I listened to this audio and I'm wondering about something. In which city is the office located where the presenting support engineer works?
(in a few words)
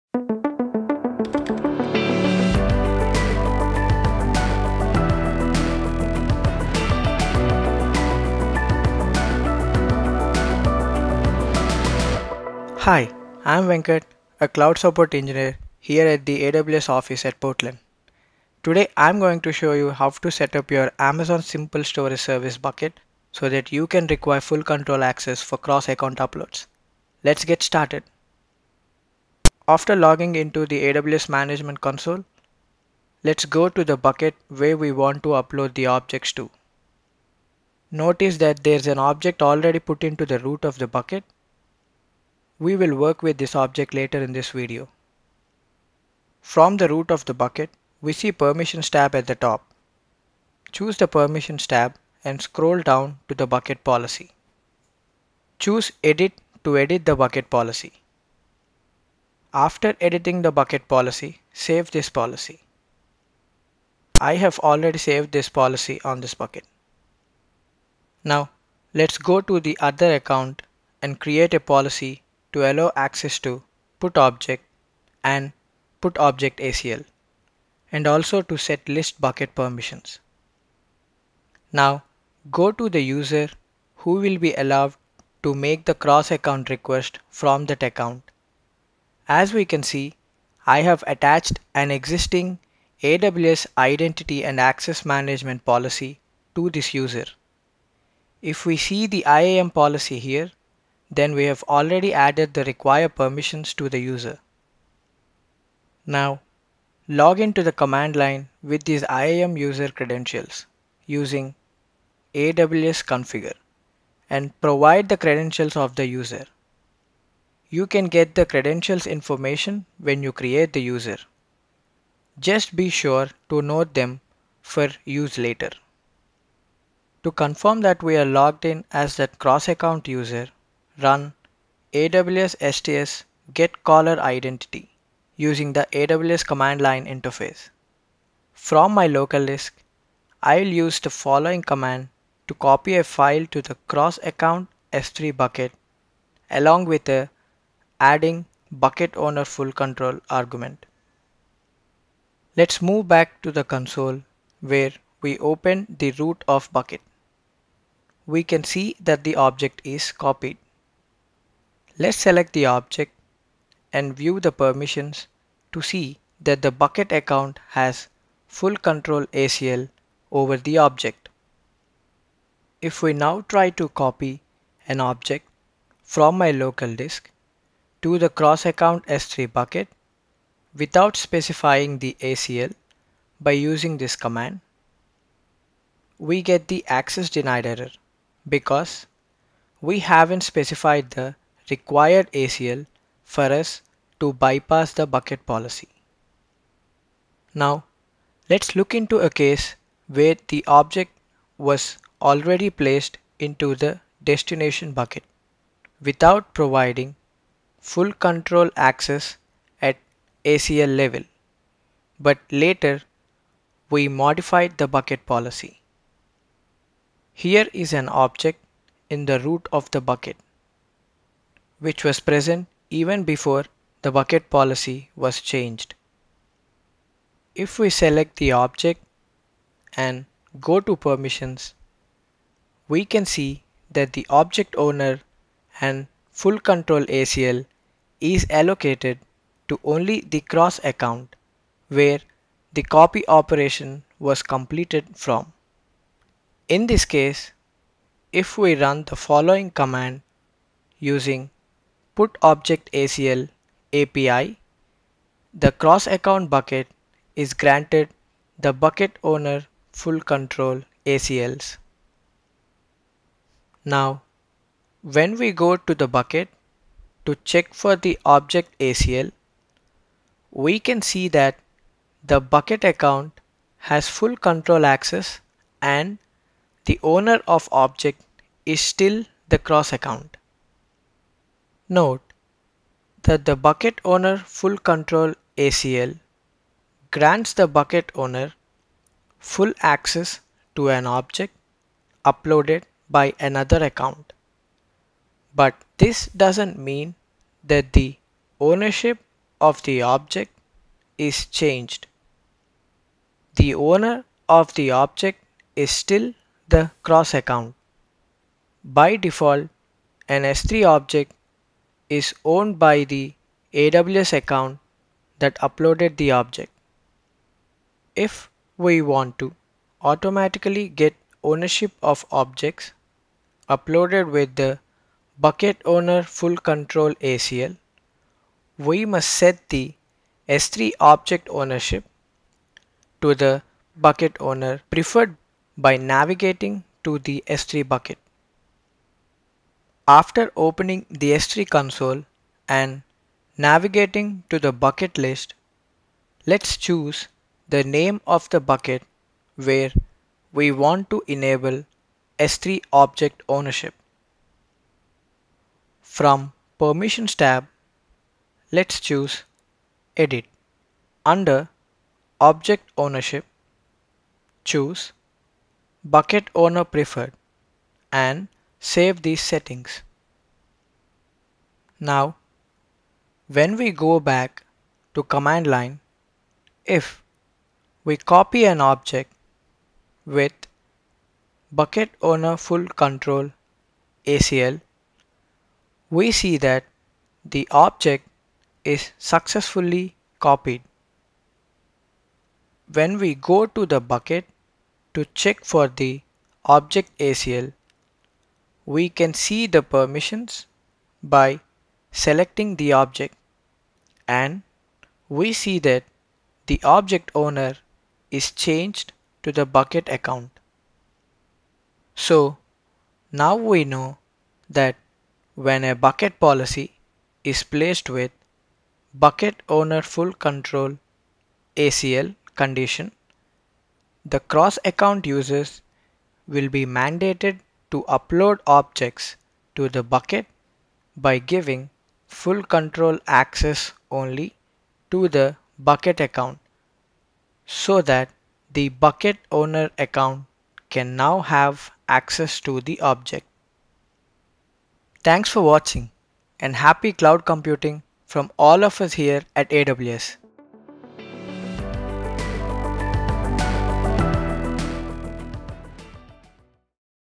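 Portland.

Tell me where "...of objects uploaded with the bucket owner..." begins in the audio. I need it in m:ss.
5:22.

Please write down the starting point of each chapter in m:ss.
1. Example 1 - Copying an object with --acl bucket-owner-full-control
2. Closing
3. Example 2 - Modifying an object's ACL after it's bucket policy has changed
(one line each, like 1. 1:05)
1. 0:29
2. 6:52
3. 3:16.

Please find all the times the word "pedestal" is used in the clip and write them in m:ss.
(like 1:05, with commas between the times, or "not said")
not said.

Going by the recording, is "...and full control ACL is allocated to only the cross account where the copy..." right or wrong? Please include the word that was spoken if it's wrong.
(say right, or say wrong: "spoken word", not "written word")
right.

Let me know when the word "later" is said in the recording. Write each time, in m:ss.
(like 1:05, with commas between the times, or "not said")
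0:43, 2:05, 3:32.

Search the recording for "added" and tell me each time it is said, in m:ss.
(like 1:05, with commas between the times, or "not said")
1:42.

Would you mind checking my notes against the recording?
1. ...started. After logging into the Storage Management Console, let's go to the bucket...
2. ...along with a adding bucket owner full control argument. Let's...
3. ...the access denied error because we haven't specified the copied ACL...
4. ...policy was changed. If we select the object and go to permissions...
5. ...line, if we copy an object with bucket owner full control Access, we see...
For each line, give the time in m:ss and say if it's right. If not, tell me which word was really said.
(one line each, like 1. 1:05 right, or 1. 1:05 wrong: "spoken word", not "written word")
1. 0:27 wrong: "AWS", not "Storage"
2. 2:26 right
3. 3:06 wrong: "required", not "copied"
4. 3:44 right
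5. 6:15 wrong: "ACL", not "Access".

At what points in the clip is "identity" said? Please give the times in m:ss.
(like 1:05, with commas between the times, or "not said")
1:33, 2:14.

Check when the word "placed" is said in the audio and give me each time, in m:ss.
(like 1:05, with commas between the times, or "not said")
3:22, 6:57.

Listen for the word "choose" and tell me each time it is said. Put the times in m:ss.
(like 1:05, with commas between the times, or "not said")
0:50, 0:55, 5:46, 5:58, 6:04.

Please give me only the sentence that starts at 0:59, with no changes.
After editing the bucket policy, save this policy.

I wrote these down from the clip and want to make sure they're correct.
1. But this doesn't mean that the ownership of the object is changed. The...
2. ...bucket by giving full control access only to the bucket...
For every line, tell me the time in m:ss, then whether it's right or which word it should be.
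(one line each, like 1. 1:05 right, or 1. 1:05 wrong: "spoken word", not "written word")
1. 4:55 right
2. 7:10 right.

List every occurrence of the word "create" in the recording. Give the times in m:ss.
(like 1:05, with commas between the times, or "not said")
1:11, 2:00.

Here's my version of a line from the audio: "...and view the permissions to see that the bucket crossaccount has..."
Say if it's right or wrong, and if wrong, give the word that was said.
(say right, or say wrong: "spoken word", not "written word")
wrong: "account", not "crossaccount".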